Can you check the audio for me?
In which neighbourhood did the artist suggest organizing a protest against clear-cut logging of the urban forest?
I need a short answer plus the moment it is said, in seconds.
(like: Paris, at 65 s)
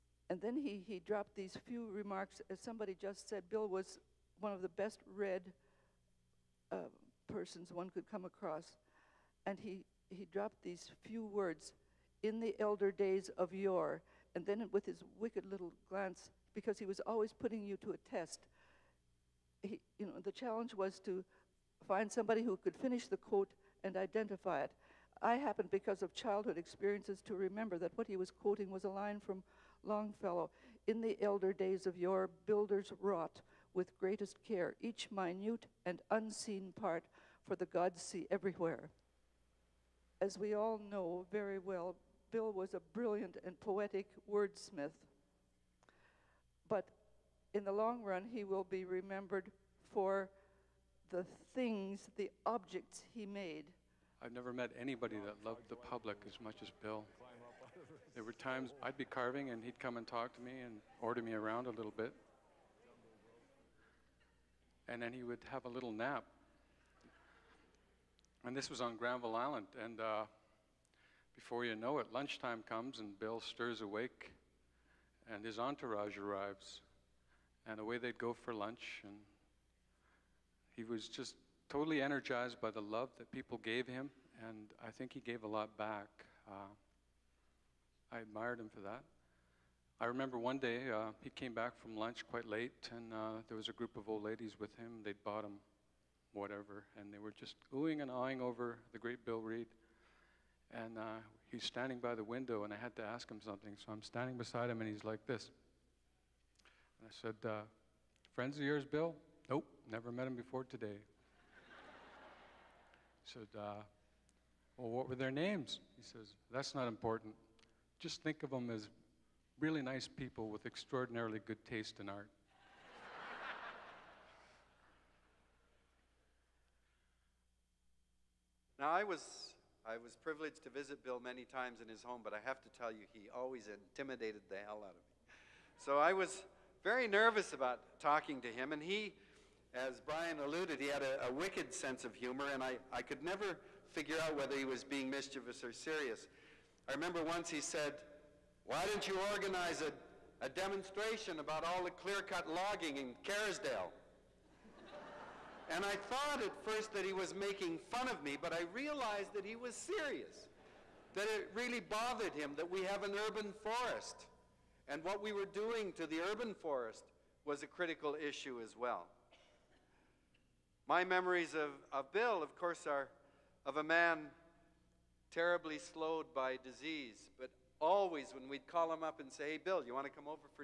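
Kerrisdale, at 153 s.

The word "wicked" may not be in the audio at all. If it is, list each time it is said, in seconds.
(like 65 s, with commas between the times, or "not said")
15 s, 141 s.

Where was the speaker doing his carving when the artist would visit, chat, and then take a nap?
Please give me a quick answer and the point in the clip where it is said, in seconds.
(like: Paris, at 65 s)
Granville Island, at 68 s.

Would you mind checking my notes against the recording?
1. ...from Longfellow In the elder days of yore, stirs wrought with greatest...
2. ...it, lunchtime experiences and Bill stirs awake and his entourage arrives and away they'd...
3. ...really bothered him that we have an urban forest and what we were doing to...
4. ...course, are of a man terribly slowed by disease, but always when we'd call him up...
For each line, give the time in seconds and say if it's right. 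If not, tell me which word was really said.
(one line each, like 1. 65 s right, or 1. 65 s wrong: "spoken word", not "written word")
1. 29 s wrong: "builders", not "stirs"
2. 71 s wrong: "comes", not "experiences"
3. 161 s right
4. 172 s right.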